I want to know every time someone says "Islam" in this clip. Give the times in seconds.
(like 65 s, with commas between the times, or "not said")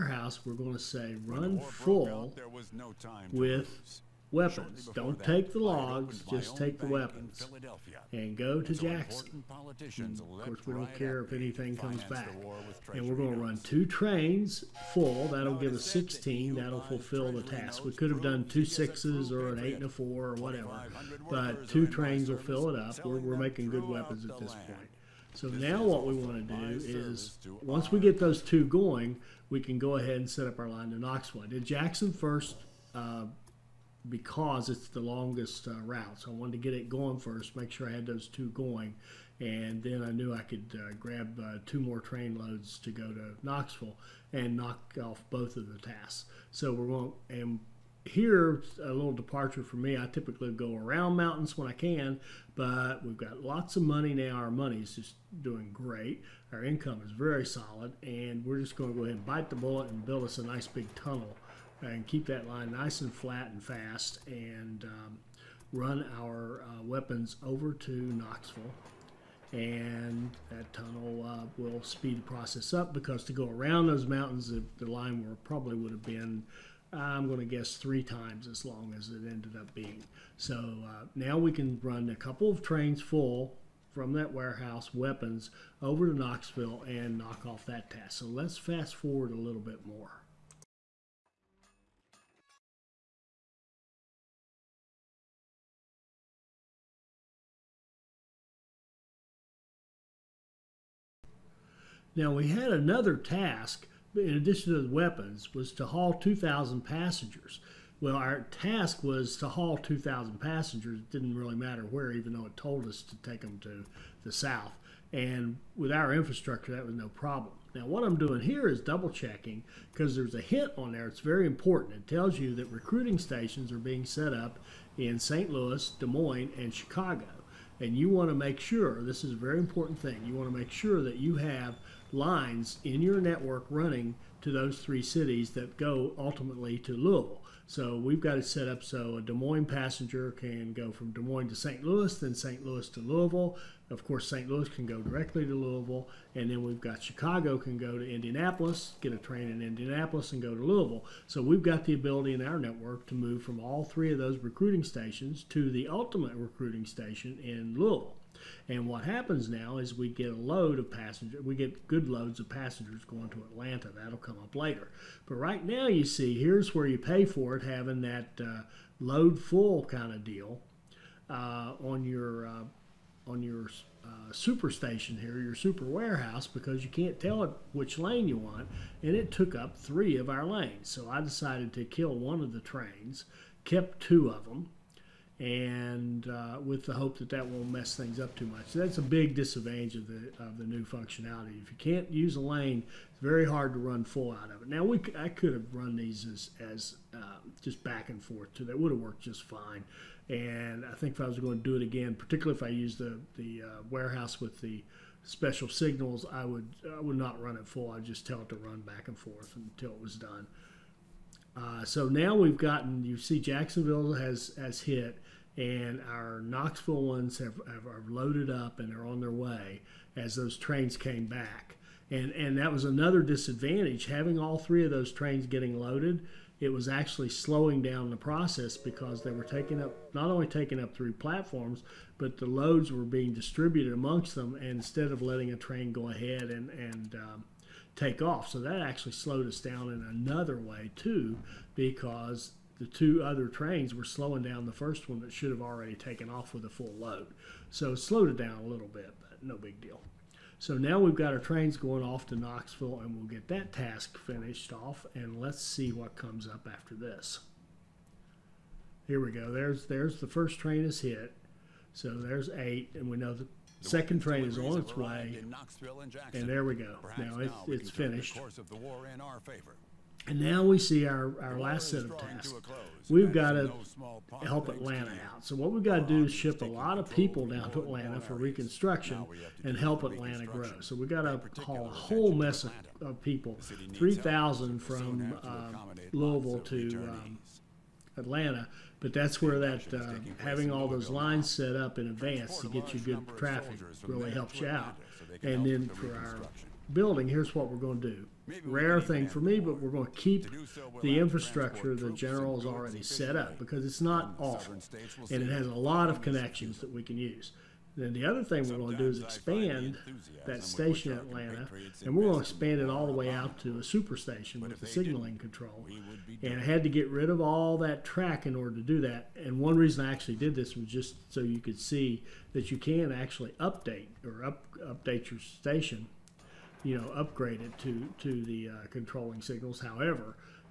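not said.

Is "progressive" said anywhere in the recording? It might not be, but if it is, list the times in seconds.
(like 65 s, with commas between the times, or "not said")
not said.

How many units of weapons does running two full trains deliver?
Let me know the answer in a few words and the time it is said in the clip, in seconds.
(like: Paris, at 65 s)
16, at 15 s.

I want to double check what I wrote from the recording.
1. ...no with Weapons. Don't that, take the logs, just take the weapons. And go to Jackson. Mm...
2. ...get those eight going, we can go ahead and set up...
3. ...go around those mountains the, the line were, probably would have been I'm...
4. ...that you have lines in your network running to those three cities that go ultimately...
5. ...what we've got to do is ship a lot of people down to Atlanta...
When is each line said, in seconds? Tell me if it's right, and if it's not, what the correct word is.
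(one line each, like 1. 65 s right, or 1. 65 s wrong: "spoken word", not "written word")
1. 2 s right
2. 28 s wrong: "two", not "eight"
3. 73 s right
4. 131 s right
5. 275 s right.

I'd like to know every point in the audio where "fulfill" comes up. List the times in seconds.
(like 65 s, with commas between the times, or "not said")
16 s.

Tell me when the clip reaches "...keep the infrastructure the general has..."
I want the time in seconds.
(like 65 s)
300 s.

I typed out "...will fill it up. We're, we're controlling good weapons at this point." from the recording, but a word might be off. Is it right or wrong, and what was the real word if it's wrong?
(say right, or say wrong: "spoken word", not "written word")
wrong: "making", not "controlling".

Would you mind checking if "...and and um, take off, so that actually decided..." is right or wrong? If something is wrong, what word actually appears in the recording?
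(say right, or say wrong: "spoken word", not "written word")
wrong: "slowed", not "decided".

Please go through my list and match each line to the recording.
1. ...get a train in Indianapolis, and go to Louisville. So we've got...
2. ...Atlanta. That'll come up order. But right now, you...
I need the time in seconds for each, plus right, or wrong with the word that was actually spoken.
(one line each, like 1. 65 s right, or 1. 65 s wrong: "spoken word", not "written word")
1. 149 s right
2. 163 s wrong: "later", not "order".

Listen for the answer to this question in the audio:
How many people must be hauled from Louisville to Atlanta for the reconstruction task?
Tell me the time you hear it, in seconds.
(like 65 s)
283 s.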